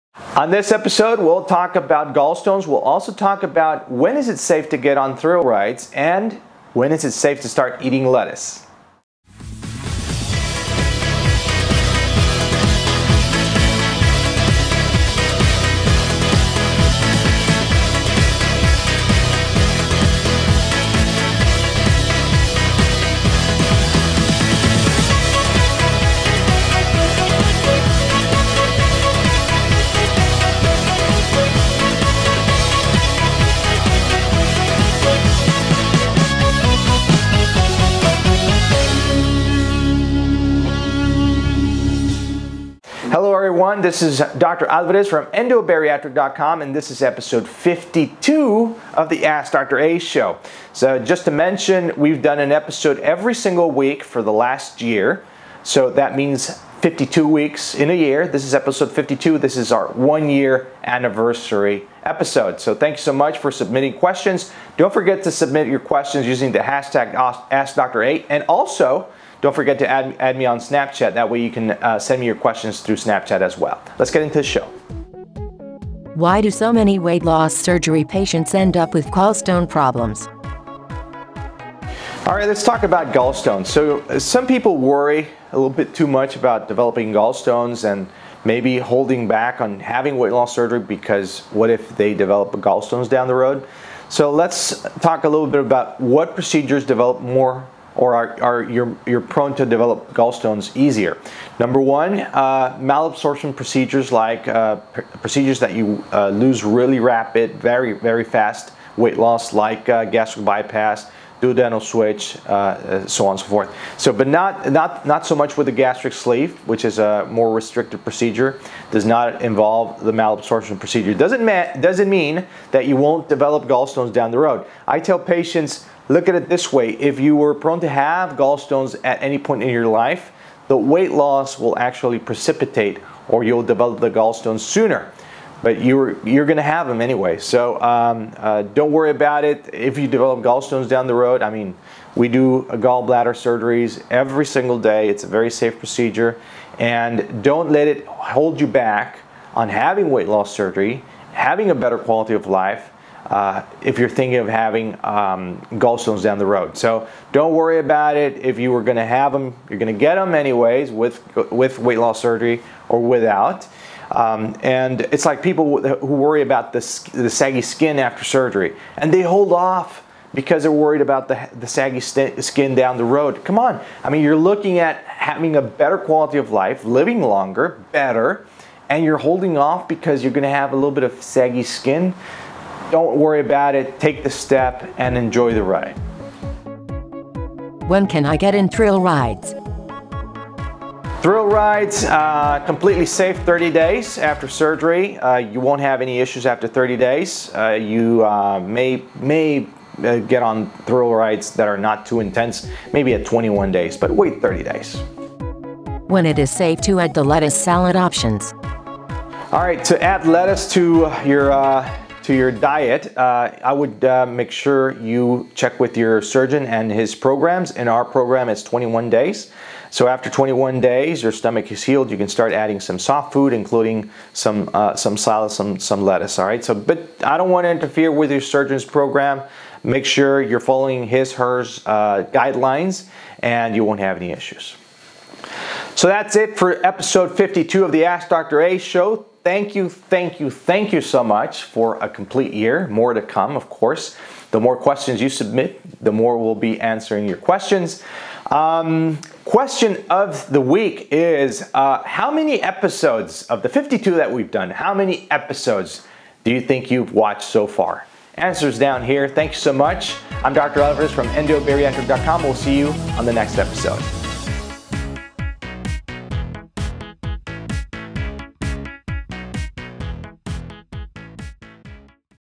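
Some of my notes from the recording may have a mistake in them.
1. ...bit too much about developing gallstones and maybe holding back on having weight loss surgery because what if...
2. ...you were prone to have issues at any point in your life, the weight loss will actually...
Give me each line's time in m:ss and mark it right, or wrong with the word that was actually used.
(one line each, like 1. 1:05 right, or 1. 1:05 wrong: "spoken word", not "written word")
1. 1:25 right
2. 2:07 wrong: "gallstones", not "issues".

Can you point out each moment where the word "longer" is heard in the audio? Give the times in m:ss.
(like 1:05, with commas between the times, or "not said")
2:57.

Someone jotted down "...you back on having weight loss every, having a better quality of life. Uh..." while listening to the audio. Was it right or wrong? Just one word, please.
wrong.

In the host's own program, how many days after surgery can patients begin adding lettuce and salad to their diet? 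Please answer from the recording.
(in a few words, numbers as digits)
21 days.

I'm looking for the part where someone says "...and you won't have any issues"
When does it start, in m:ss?
3:53.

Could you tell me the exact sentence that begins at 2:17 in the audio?
So um, uh, don't worry about it.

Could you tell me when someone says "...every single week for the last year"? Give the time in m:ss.
0:52.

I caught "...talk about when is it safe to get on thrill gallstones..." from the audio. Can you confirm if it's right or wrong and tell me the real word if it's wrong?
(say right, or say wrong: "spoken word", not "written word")
wrong: "rides", not "gallstones".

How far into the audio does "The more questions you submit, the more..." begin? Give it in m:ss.
4:04.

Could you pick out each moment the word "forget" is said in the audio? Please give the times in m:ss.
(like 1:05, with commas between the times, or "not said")
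1:04, 1:09.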